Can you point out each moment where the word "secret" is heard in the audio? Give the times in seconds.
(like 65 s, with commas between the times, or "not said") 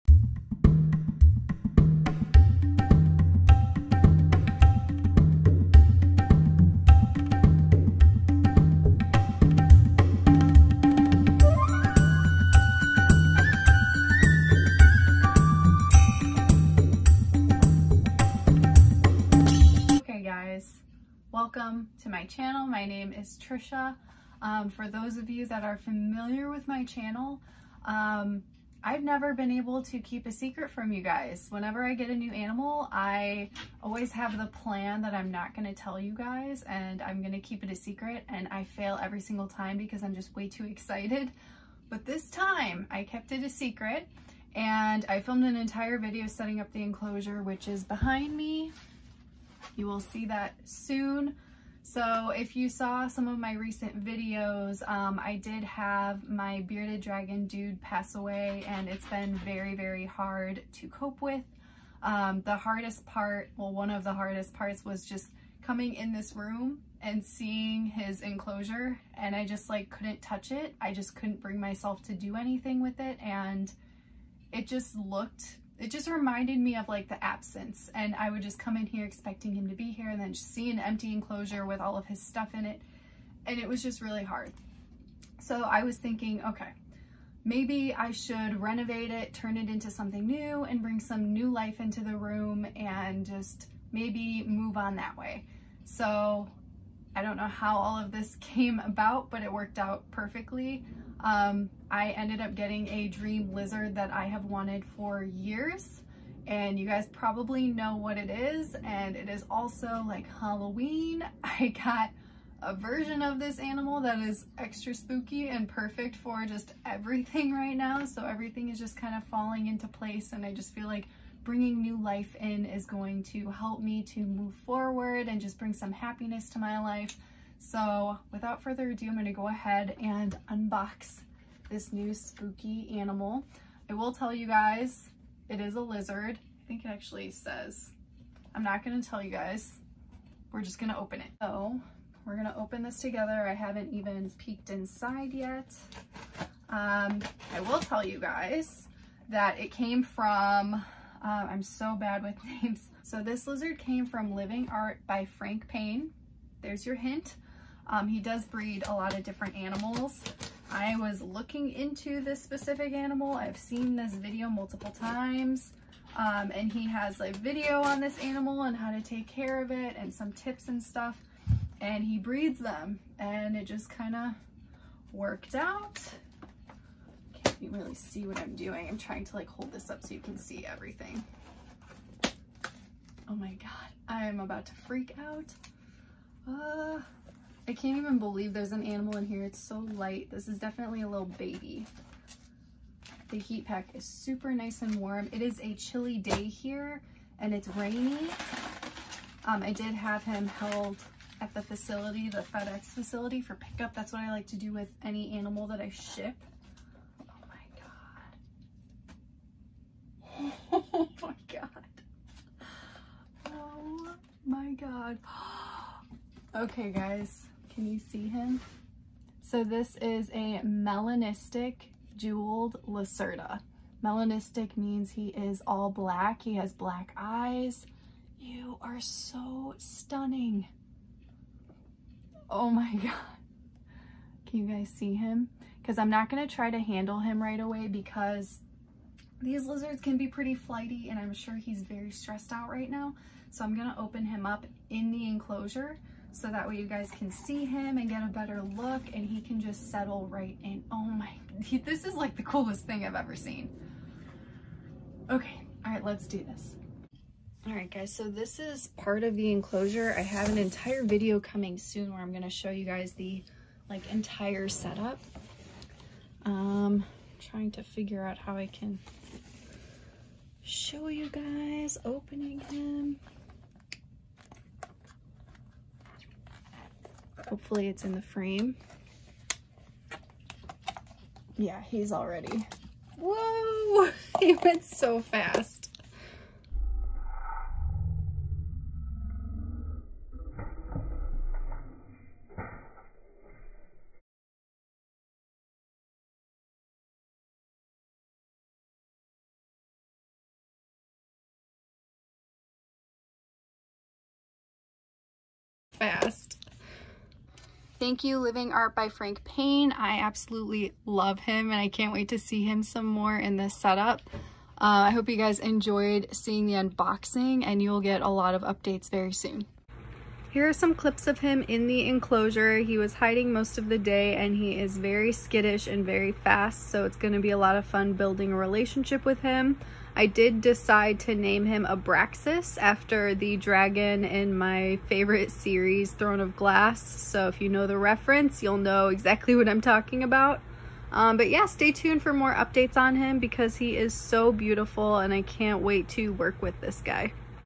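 30 s, 37 s, 43 s.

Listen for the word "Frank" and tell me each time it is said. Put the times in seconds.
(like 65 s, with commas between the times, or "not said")
155 s, 309 s.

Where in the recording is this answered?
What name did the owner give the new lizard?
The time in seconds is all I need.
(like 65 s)
331 s.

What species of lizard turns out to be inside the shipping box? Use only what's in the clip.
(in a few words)
jeweled lacerta.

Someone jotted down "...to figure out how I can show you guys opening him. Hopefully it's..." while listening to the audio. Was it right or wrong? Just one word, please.
right.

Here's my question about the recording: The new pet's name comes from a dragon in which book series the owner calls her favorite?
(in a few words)
Throne of Glass.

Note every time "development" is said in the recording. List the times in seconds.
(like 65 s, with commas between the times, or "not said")
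not said.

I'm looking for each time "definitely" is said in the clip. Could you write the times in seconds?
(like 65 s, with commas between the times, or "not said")
190 s.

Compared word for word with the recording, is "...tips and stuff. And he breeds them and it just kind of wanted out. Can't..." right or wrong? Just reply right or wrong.
wrong.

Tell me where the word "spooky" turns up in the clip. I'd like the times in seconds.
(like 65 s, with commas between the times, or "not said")
114 s, 132 s.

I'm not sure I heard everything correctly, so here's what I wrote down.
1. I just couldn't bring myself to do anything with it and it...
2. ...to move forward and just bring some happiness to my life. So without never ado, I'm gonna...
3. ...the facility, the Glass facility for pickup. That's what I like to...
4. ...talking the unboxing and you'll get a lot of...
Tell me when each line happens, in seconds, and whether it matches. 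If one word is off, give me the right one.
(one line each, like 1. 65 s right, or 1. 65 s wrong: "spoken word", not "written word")
1. 70 s right
2. 124 s wrong: "further", not "never"
3. 201 s wrong: "FedEx", not "Glass"
4. 316 s wrong: "seeing", not "talking".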